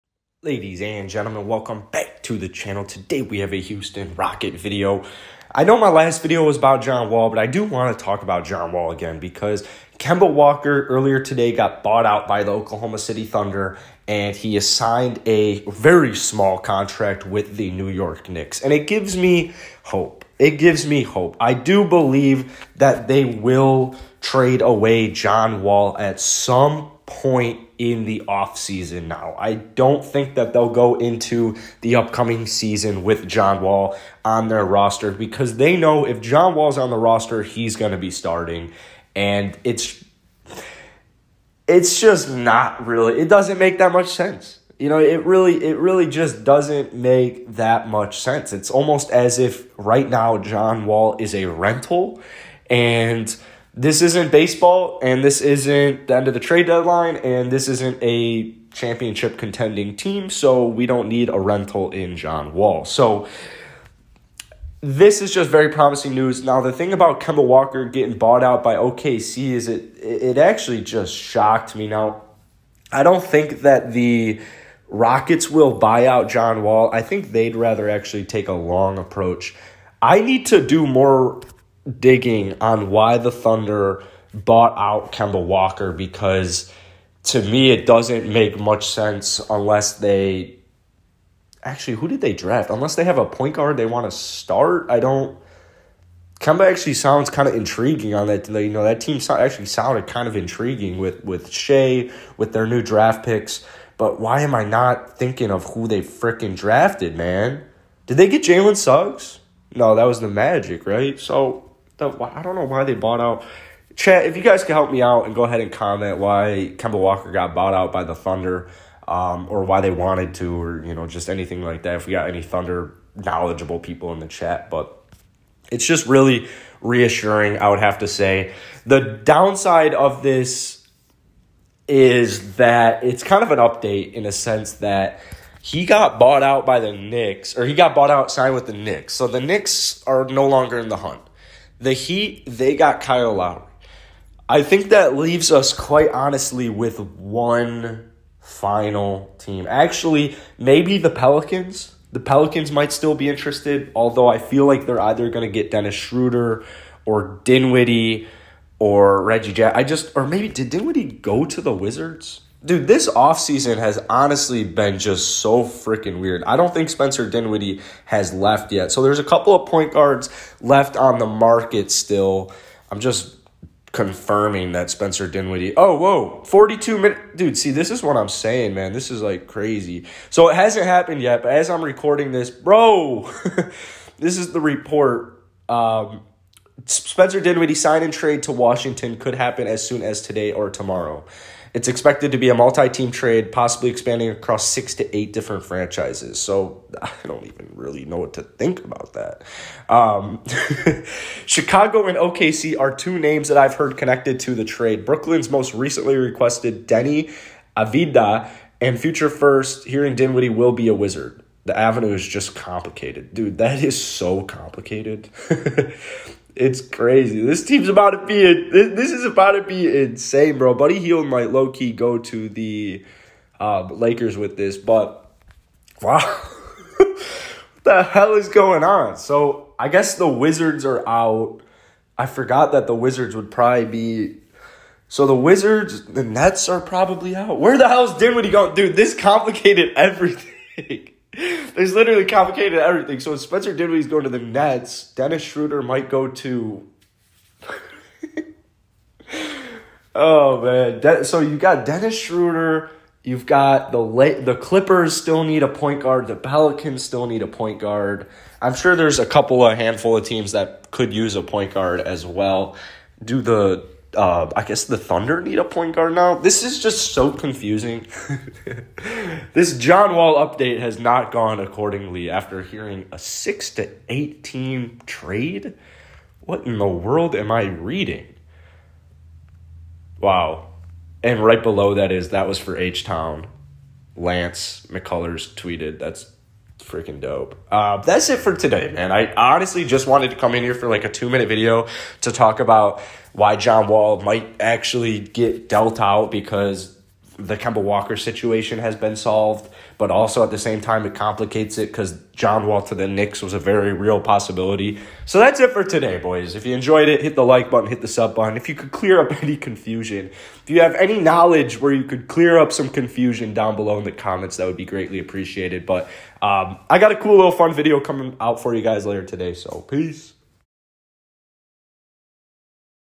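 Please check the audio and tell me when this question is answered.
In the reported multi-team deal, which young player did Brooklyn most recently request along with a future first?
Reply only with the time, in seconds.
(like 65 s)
206 s.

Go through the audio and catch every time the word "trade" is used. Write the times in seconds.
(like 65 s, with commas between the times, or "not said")
24 s, 56 s, 188 s, 193 s, 204 s, 275 s.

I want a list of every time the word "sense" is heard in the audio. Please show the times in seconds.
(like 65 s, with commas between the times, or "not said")
44 s, 48 s, 88 s, 134 s.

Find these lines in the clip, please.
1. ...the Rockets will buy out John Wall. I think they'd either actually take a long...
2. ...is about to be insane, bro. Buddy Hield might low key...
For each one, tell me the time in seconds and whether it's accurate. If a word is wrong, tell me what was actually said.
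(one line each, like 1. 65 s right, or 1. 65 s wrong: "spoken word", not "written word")
1. 73 s wrong: "rather", not "either"
2. 219 s right.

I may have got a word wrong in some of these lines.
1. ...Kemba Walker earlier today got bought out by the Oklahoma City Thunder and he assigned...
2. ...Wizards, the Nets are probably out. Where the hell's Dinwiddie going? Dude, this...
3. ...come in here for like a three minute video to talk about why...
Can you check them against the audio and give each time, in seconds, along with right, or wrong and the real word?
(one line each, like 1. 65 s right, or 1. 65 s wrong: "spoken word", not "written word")
1. 9 s right
2. 235 s right
3. 290 s wrong: "two", not "three".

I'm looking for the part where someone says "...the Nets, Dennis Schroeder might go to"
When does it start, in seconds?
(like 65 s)
244 s.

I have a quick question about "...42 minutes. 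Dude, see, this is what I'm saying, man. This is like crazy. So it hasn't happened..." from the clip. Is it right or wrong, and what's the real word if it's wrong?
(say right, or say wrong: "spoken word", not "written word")
right.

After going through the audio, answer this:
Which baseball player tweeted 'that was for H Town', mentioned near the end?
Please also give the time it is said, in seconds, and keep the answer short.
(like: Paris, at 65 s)
Lance McCullers, at 284 s.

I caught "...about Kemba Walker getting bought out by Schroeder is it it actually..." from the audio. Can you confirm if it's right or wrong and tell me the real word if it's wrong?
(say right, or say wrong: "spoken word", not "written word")
wrong: "OKC", not "Schroeder".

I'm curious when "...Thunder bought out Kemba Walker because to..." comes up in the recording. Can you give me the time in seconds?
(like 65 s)
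83 s.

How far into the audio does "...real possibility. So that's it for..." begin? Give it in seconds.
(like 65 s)
303 s.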